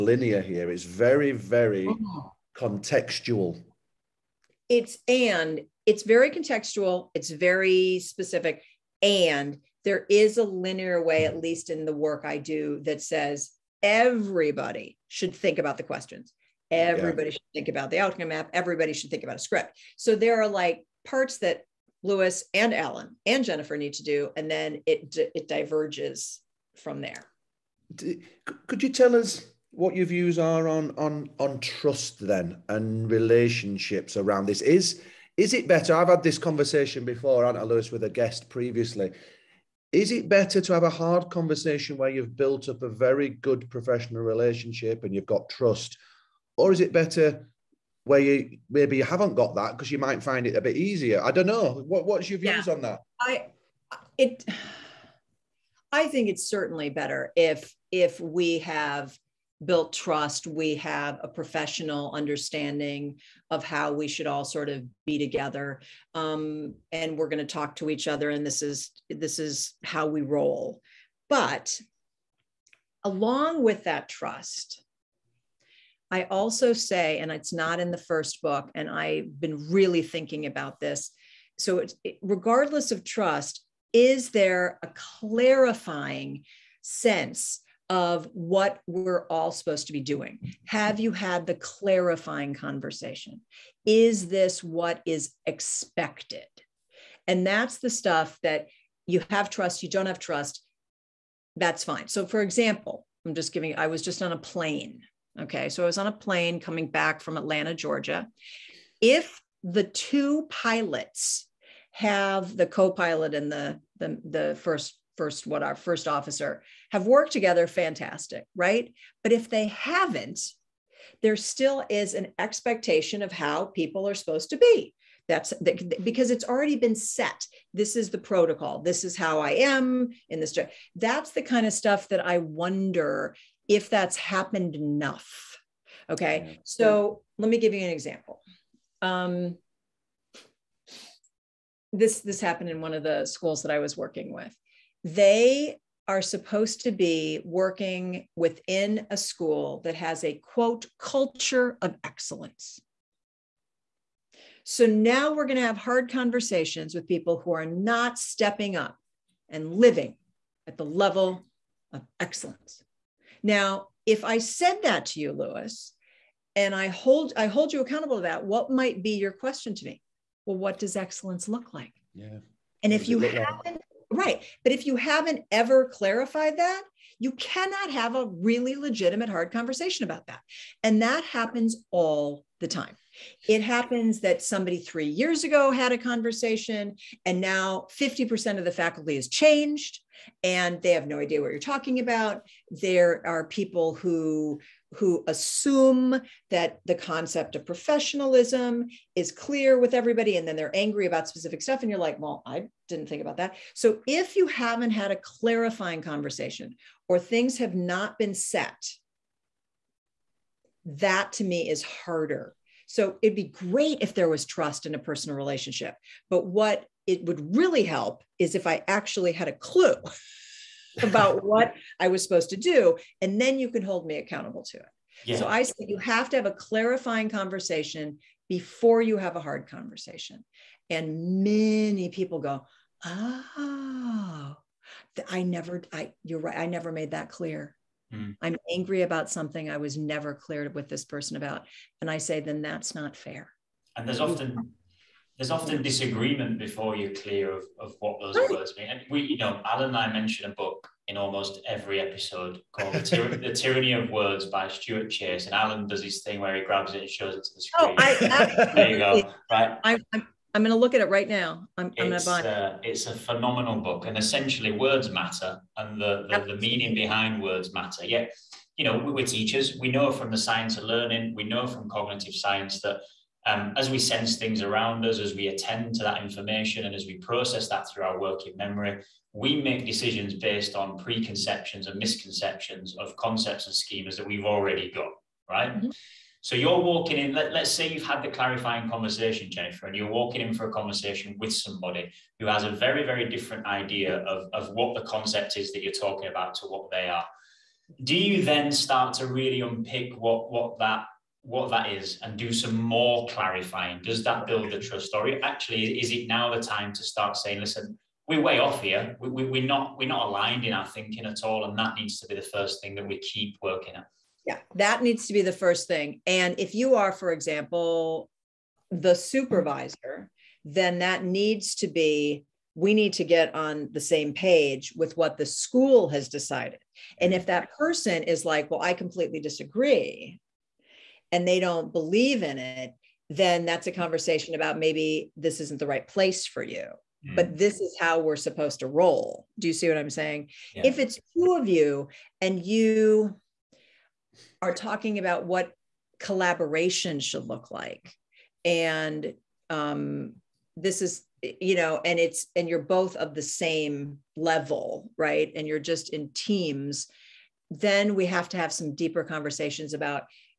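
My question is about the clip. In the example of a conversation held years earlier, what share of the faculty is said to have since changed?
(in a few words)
50%.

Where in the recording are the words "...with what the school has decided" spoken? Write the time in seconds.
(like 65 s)
324 s.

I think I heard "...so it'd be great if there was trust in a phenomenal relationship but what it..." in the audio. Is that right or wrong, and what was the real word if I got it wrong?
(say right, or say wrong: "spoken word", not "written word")
wrong: "personal", not "phenomenal".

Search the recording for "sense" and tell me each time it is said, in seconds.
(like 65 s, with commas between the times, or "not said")
86 s, 273 s.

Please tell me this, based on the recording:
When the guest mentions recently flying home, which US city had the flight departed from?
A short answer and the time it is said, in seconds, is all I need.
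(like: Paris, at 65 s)
Atlanta, Georgia, at 107 s.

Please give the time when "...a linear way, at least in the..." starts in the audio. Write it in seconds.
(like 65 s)
10 s.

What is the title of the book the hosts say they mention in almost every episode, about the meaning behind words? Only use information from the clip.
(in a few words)
The Tyranny of Words.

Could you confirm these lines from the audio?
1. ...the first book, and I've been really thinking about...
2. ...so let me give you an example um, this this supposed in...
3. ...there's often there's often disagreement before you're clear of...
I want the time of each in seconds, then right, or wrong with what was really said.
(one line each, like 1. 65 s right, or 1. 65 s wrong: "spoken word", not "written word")
1. 77 s right
2. 136 s wrong: "happened", not "supposed"
3. 244 s right.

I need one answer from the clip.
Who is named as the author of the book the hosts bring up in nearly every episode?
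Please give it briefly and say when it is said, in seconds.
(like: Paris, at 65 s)
Stuart Chase, at 254 s.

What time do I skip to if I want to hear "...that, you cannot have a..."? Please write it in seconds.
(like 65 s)
176 s.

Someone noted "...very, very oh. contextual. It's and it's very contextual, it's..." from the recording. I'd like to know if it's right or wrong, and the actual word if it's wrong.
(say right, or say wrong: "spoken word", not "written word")
right.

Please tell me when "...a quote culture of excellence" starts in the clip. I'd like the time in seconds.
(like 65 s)
150 s.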